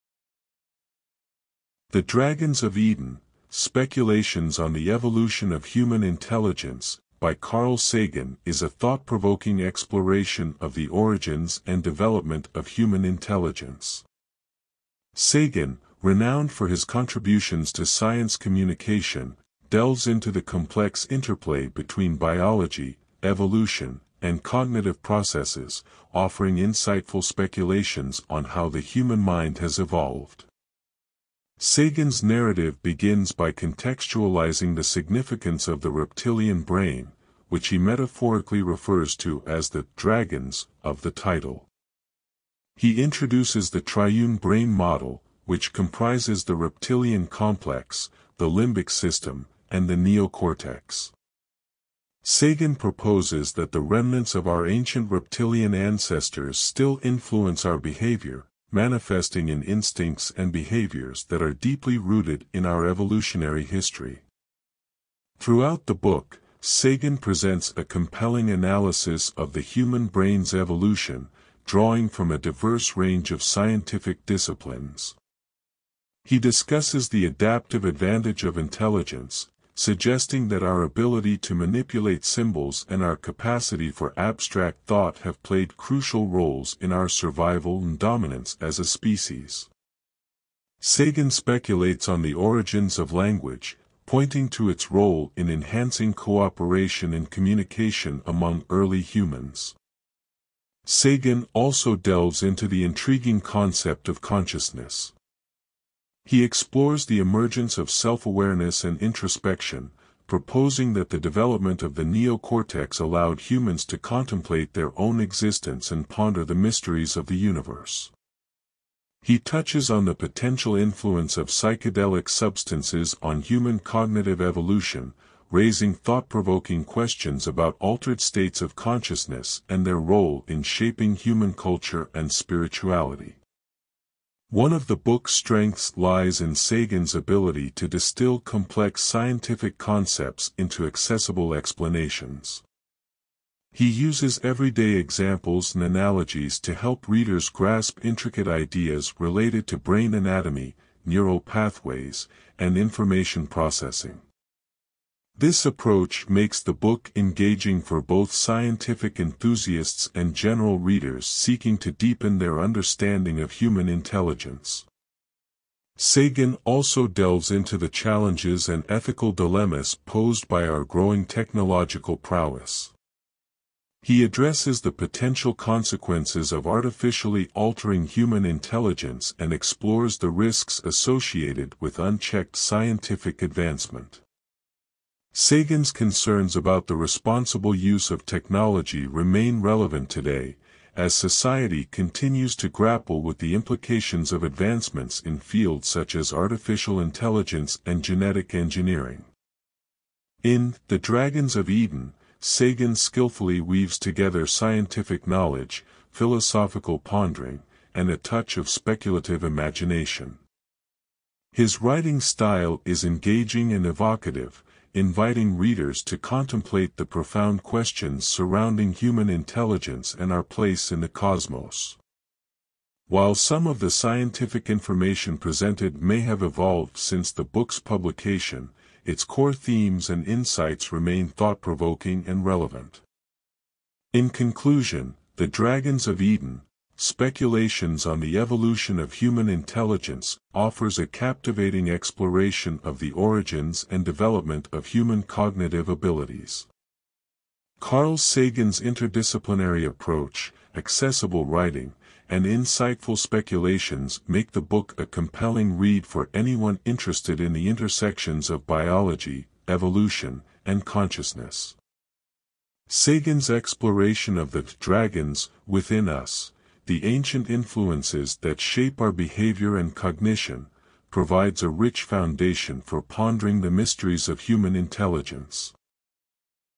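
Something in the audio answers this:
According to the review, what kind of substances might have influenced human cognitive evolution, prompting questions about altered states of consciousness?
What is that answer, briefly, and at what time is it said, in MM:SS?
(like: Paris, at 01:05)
psychedelic substances, at 02:01.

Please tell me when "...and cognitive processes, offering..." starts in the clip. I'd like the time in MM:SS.
00:24.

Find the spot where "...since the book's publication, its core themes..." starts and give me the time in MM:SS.
03:46.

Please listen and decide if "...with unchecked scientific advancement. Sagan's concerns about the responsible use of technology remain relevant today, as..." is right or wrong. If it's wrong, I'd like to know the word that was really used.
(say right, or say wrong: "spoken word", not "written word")
right.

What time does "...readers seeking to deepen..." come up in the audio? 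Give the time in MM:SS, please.
02:40.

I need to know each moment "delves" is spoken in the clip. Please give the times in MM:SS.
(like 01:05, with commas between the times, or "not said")
00:19, 01:41, 02:47.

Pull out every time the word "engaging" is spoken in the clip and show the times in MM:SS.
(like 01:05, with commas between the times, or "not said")
02:37, 03:33.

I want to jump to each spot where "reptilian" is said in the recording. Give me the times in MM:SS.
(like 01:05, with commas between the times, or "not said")
00:35, 00:46, 00:55.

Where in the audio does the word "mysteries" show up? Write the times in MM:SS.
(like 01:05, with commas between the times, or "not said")
01:56, 04:33.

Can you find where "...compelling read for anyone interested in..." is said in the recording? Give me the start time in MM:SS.
04:15.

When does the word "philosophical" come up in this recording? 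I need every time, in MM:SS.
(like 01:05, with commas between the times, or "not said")
03:26.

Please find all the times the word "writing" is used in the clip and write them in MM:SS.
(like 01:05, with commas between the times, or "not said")
03:31, 04:11.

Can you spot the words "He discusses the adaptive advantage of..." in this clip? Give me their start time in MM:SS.
01:16.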